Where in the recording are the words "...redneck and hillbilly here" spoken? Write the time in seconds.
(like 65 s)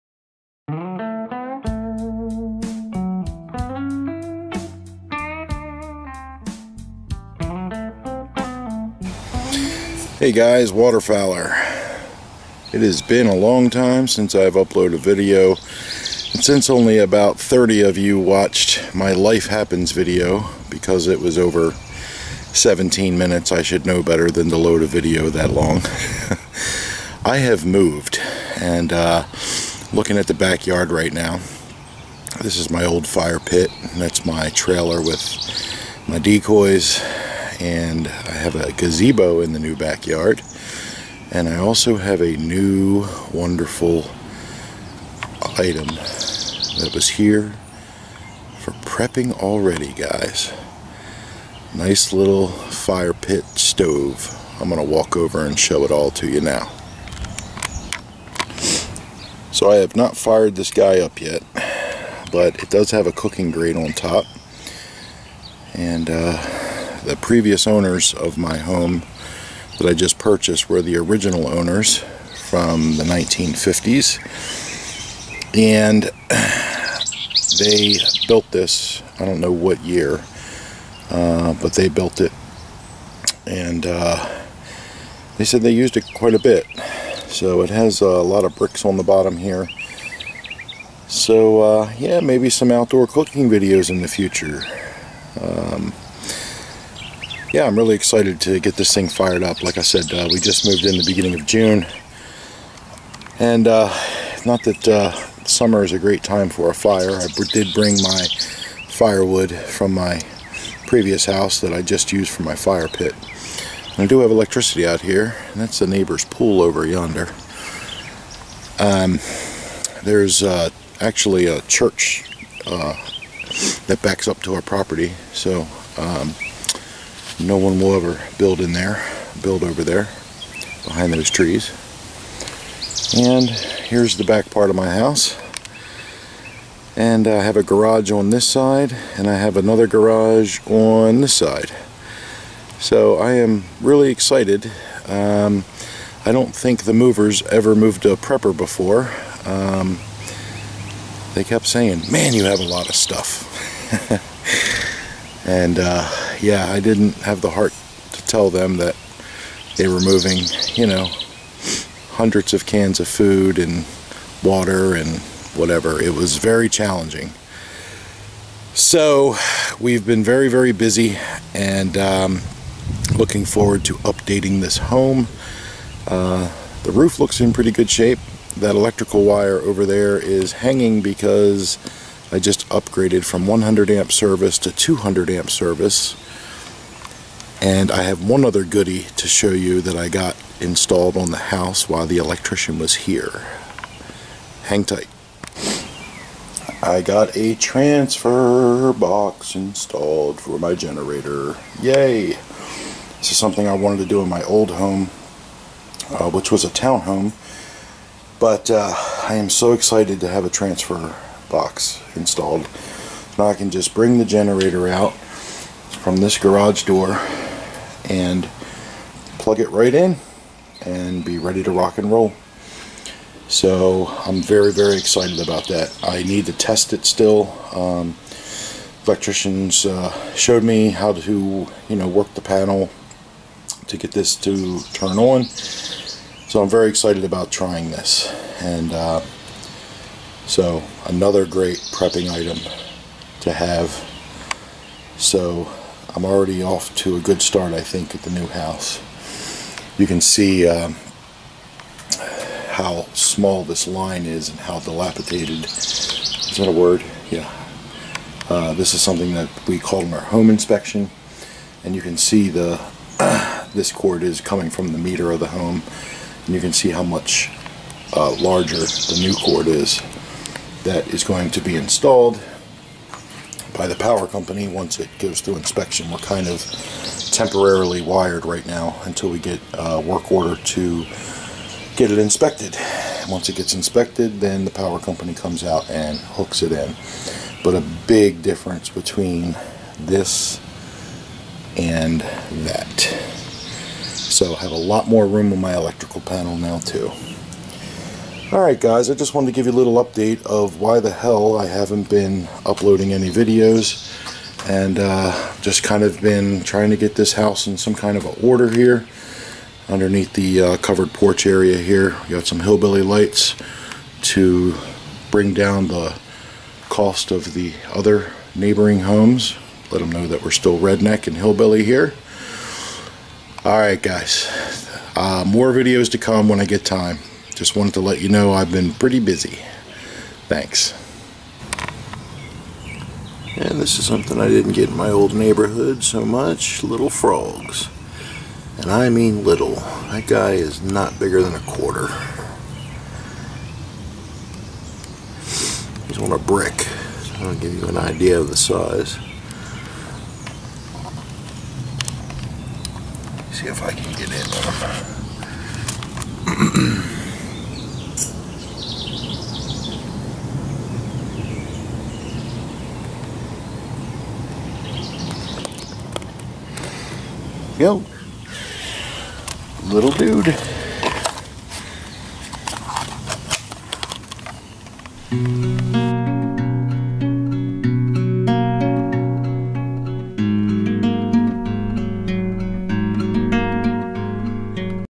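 320 s.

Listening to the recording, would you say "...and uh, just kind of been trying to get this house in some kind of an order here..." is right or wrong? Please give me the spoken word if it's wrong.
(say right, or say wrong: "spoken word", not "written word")
right.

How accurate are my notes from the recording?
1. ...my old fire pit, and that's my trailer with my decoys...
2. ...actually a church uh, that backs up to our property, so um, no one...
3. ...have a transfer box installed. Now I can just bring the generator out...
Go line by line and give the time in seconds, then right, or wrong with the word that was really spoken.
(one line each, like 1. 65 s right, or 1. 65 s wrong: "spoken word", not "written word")
1. 32 s right
2. 121 s right
3. 210 s right.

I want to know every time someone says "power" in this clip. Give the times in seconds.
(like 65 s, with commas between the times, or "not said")
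273 s, 284 s.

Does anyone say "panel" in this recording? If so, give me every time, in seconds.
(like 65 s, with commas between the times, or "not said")
232 s, 296 s.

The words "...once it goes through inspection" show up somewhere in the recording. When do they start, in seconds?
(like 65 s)
274 s.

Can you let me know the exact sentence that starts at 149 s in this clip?
Um, they kept saying, man, you have a lot of stuff.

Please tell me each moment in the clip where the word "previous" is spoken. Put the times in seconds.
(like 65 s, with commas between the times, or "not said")
67 s, 110 s.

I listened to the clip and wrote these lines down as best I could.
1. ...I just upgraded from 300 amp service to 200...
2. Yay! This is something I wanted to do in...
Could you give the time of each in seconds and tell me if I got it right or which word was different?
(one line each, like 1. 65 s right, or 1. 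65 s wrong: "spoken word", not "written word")
1. 182 s wrong: "100", not "300"
2. 201 s right.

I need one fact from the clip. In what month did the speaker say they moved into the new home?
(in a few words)
June.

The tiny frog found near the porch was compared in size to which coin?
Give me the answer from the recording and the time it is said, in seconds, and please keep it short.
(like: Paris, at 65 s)
Quarter, at 341 s.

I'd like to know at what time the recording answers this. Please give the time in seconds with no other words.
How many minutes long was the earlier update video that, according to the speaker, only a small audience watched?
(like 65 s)
22 s.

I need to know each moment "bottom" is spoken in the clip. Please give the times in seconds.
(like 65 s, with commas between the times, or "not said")
89 s.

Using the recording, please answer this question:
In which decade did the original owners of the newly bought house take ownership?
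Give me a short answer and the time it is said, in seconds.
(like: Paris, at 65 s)
1950s, at 73 s.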